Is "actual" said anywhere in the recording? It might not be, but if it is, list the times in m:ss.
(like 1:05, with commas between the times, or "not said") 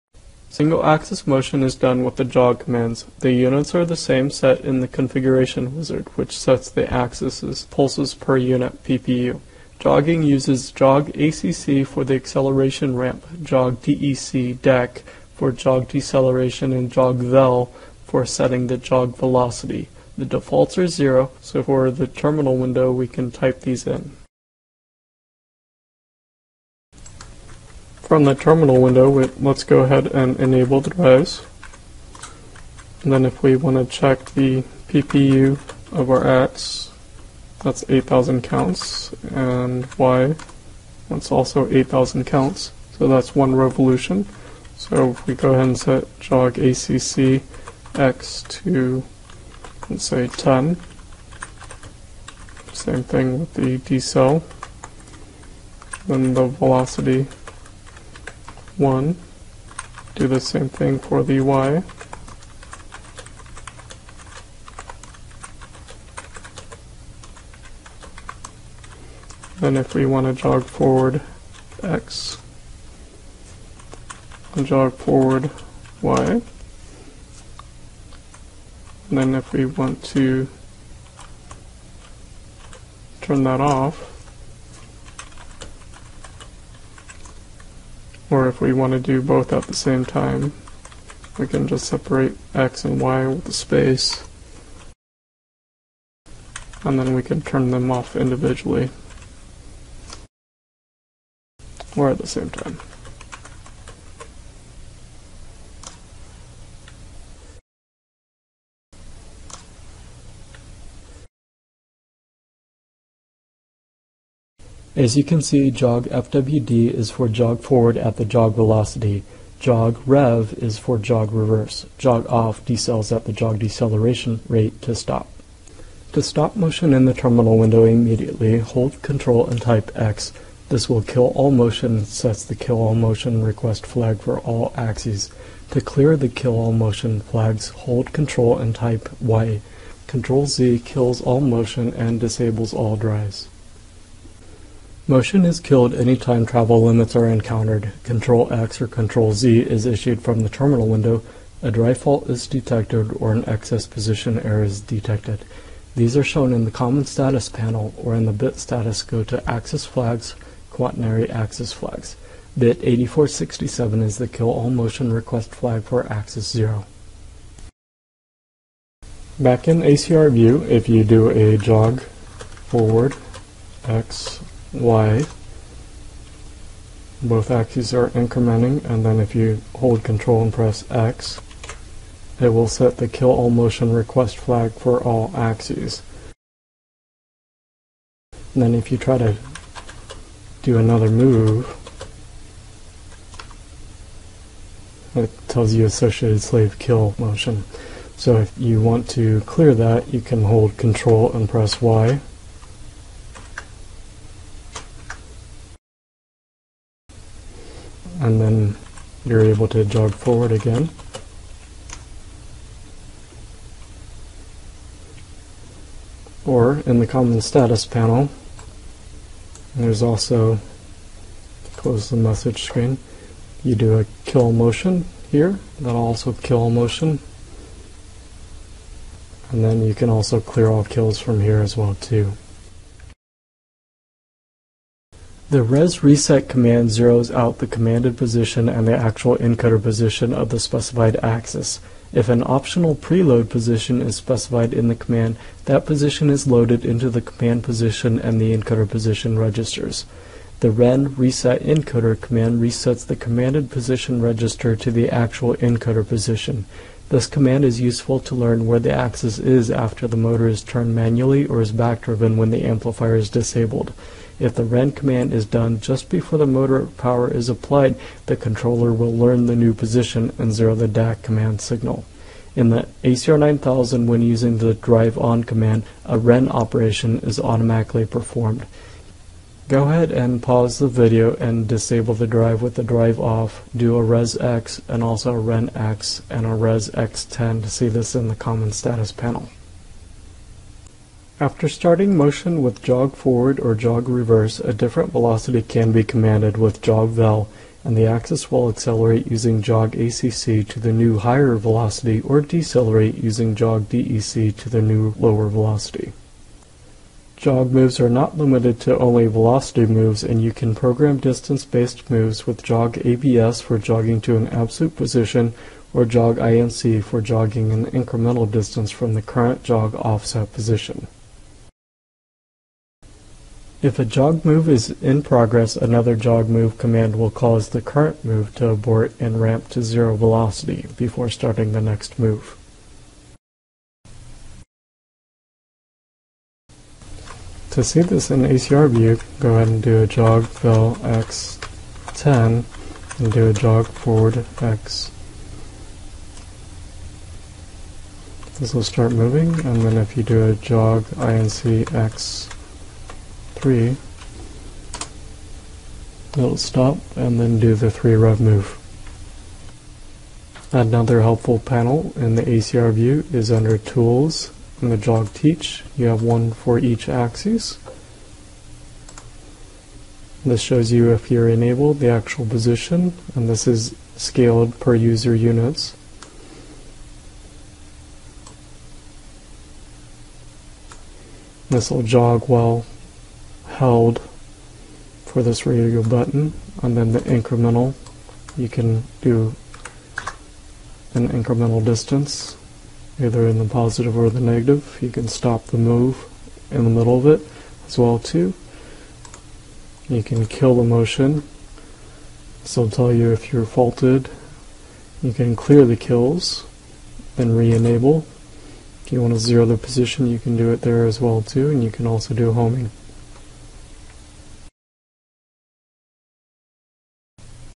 3:58, 4:15, 6:12.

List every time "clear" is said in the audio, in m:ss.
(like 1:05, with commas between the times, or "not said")
2:15, 3:19, 3:50, 6:45.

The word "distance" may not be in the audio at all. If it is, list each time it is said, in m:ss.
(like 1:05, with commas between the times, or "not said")
5:11, 5:18, 6:31.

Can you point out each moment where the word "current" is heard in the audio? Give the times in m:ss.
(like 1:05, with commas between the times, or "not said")
5:19, 5:27.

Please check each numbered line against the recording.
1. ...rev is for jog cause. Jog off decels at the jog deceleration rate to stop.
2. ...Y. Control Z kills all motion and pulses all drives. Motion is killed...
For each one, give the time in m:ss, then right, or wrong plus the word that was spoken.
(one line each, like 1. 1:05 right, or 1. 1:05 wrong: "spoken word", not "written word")
1. 2:00 wrong: "reverse", not "cause"
2. 2:19 wrong: "disables", not "pulses".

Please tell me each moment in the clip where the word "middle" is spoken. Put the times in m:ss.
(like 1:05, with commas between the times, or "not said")
6:36.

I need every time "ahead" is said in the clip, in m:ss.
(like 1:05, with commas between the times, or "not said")
0:29, 0:45, 4:39, 5:39.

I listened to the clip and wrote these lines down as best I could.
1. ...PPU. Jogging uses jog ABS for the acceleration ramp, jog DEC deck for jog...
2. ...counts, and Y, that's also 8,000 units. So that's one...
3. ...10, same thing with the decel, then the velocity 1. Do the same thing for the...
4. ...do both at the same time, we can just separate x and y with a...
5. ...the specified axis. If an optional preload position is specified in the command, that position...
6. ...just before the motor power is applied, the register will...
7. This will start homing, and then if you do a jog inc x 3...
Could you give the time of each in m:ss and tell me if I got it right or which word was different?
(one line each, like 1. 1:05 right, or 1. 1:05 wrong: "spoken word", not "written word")
1. 0:08 wrong: "ACC", not "ABS"
2. 0:38 wrong: "counts", not "units"
3. 0:50 right
4. 1:28 right
5. 4:00 right
6. 4:25 wrong: "controller", not "register"
7. 5:48 wrong: "moving", not "homing".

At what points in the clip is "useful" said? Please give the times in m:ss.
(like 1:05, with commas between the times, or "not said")
4:17.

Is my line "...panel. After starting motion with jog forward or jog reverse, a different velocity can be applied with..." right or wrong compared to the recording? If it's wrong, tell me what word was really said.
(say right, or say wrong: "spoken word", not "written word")
wrong: "commanded", not "applied".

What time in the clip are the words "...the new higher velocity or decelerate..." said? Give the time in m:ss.
5:00.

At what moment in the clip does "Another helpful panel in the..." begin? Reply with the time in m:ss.
6:00.